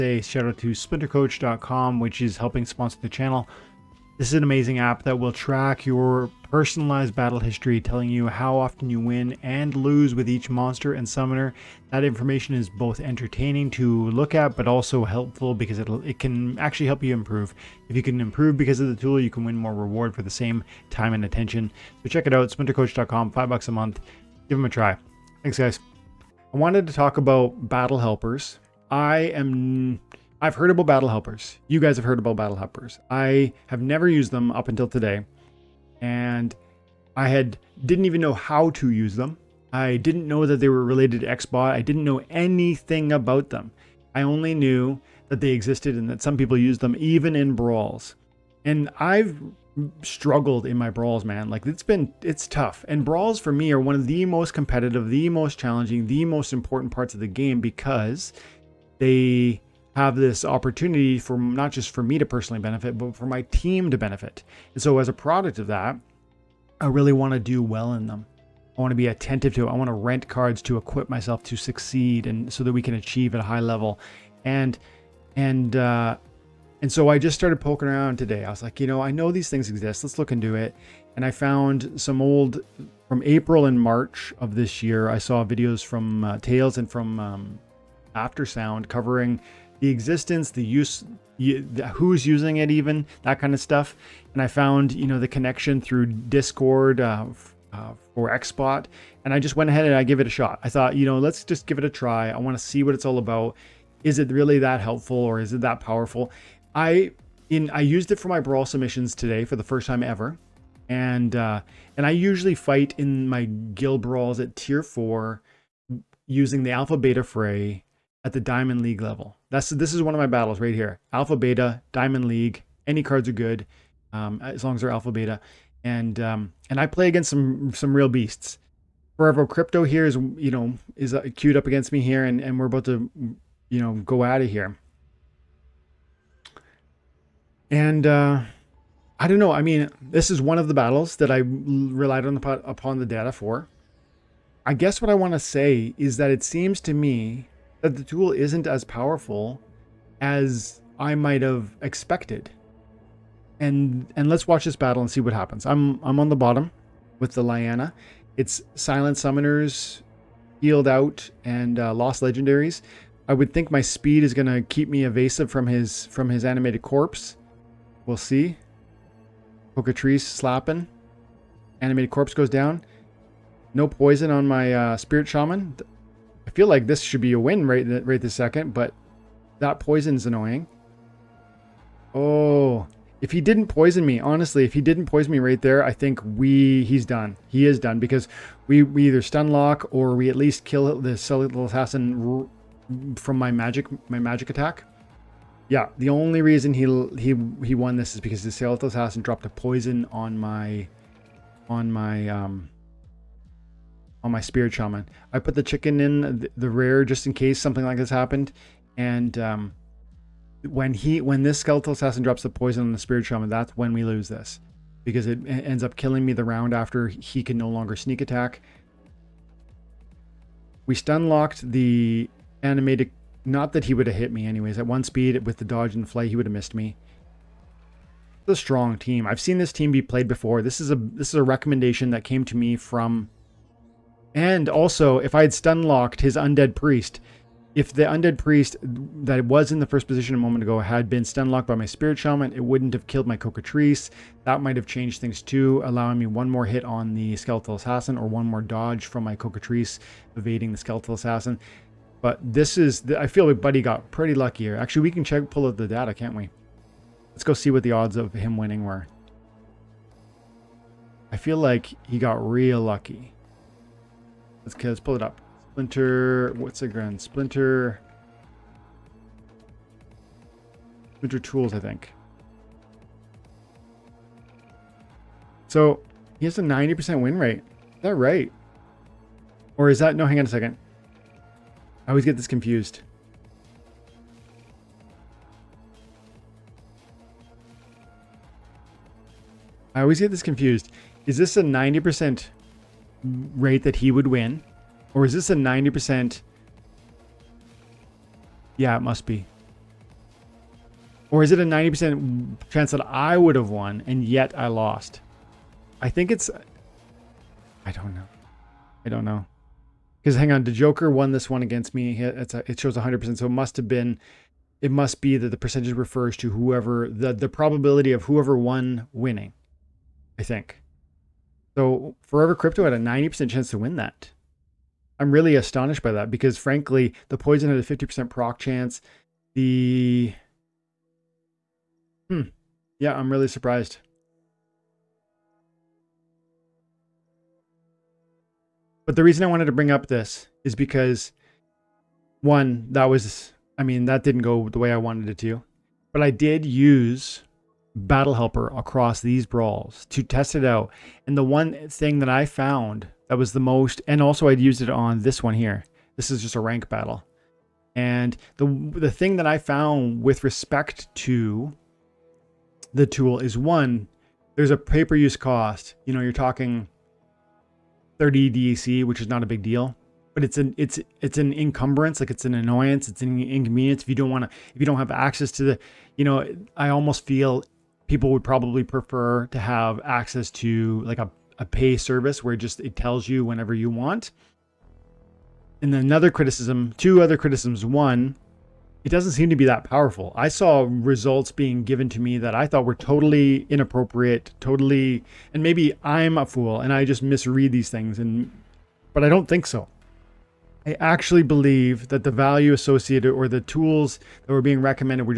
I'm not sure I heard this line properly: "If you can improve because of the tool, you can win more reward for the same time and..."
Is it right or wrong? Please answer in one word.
right.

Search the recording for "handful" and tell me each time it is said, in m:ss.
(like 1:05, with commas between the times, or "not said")
not said.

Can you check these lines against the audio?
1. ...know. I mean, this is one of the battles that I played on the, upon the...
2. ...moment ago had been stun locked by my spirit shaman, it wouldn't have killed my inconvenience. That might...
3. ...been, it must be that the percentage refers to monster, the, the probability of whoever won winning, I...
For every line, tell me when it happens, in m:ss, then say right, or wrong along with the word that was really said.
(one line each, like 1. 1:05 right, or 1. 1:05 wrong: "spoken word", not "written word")
1. 2:19 wrong: "relied", not "played"
2. 4:00 wrong: "cocatrice", not "inconvenience"
3. 5:13 wrong: "whoever", not "monster".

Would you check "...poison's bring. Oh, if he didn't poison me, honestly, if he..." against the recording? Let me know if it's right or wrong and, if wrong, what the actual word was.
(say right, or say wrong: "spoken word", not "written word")
wrong: "annoying", not "bring".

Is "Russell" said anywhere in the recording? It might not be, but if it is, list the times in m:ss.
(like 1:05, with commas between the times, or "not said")
not said.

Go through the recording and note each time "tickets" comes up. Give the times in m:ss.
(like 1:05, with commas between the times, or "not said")
not said.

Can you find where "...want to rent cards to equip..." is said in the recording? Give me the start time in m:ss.
1:09.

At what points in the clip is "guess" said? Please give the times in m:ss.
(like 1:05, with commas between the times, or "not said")
2:24.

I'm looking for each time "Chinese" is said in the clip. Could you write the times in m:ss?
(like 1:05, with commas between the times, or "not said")
not said.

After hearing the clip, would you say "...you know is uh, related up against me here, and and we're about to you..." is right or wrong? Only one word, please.
wrong.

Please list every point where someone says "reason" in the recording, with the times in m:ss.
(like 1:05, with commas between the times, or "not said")
3:16, 5:39.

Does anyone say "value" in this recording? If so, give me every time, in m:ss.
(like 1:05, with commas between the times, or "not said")
6:42.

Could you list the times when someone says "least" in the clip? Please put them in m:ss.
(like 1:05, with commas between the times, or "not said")
3:10.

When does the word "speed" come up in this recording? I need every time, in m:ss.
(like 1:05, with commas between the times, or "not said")
2:43, 3:45.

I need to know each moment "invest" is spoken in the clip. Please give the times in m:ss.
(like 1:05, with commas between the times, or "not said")
not said.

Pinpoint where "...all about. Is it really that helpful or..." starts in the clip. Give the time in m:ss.
1:43.